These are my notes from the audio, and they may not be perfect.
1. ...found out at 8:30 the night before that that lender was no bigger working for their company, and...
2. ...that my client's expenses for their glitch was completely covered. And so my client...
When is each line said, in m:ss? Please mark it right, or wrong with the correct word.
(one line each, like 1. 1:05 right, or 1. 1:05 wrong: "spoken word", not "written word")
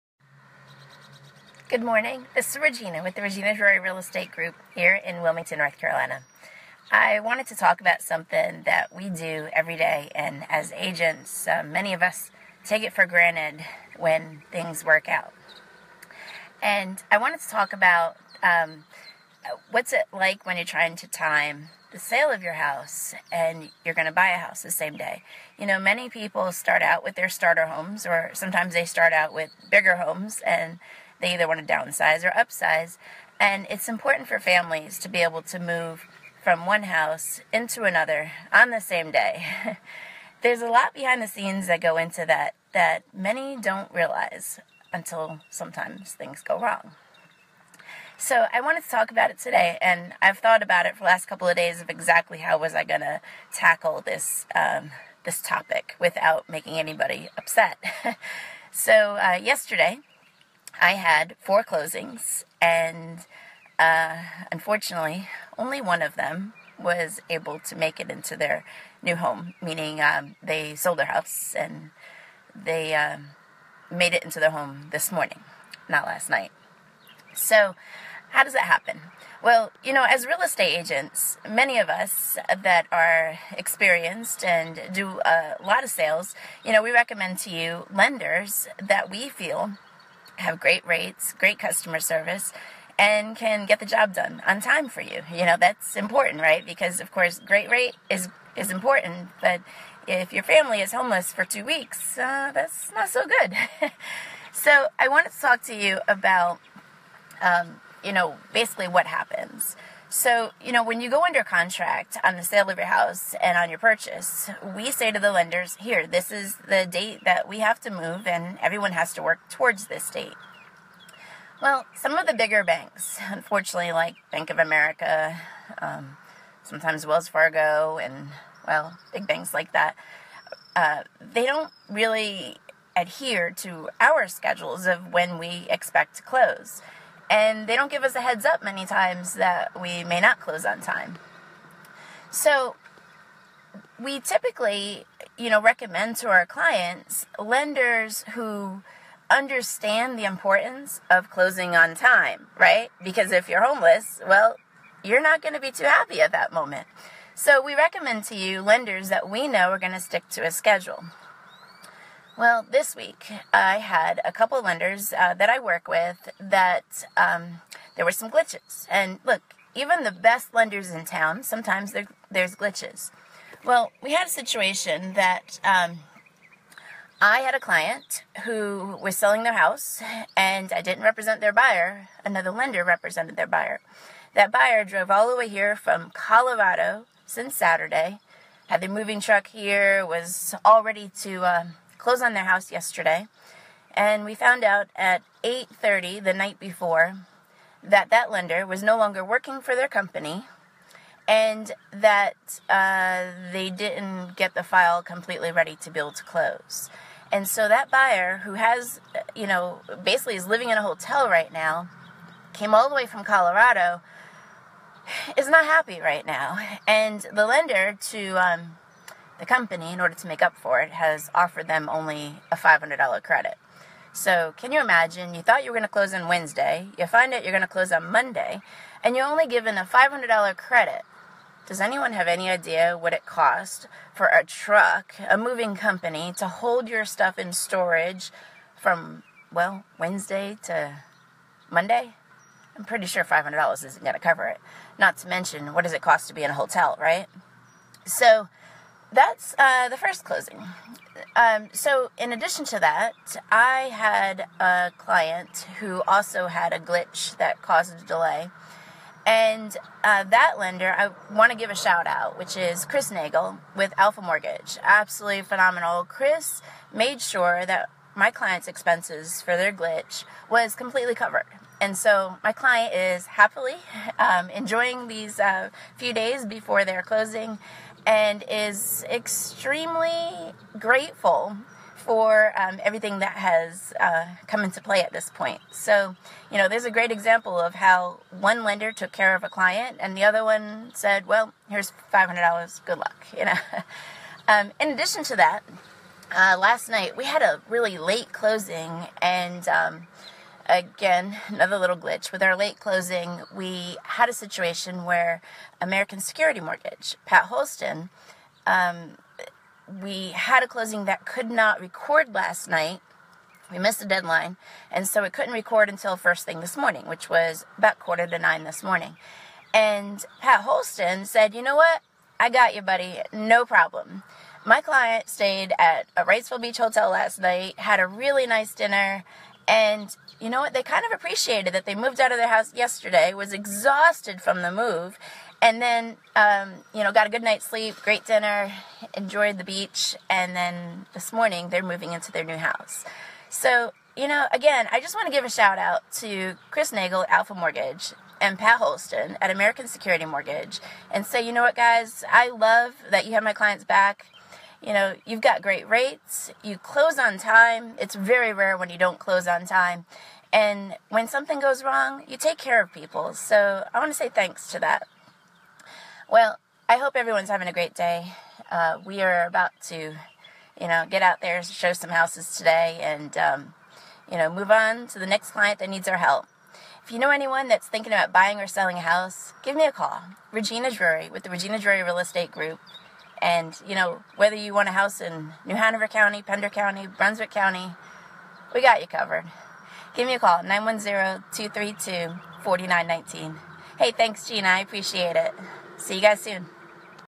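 1. 3:14 wrong: "longer", not "bigger"
2. 4:27 right.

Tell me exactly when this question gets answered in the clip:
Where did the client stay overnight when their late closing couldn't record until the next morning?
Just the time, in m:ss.
5:26.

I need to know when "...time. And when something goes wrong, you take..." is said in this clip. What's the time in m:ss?
5:59.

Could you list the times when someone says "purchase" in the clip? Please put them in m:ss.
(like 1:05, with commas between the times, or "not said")
1:53.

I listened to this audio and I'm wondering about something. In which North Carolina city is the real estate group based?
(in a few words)
Wilmington.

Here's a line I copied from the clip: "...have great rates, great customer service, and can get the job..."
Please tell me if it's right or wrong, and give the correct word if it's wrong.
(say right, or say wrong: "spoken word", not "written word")
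right.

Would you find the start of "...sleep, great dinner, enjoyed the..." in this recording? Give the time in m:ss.
5:37.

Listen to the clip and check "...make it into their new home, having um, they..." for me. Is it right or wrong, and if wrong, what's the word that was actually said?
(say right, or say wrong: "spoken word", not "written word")
wrong: "meaning", not "having".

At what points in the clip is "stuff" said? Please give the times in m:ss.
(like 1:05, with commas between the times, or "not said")
3:57.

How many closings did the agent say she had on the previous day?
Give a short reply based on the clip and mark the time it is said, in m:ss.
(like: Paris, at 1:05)
4, at 1:01.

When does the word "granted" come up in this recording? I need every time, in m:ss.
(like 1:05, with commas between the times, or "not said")
0:13.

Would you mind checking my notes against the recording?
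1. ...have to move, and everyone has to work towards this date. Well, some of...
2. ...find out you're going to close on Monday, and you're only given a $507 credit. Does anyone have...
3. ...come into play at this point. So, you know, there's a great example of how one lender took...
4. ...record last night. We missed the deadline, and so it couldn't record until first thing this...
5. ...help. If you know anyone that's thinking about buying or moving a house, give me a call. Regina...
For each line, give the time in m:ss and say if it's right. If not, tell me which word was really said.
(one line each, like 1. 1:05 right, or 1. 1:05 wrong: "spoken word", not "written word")
1. 1:57 right
2. 3:47 wrong: "500", not "507"
3. 4:44 right
4. 5:11 right
5. 6:16 wrong: "selling", not "moving".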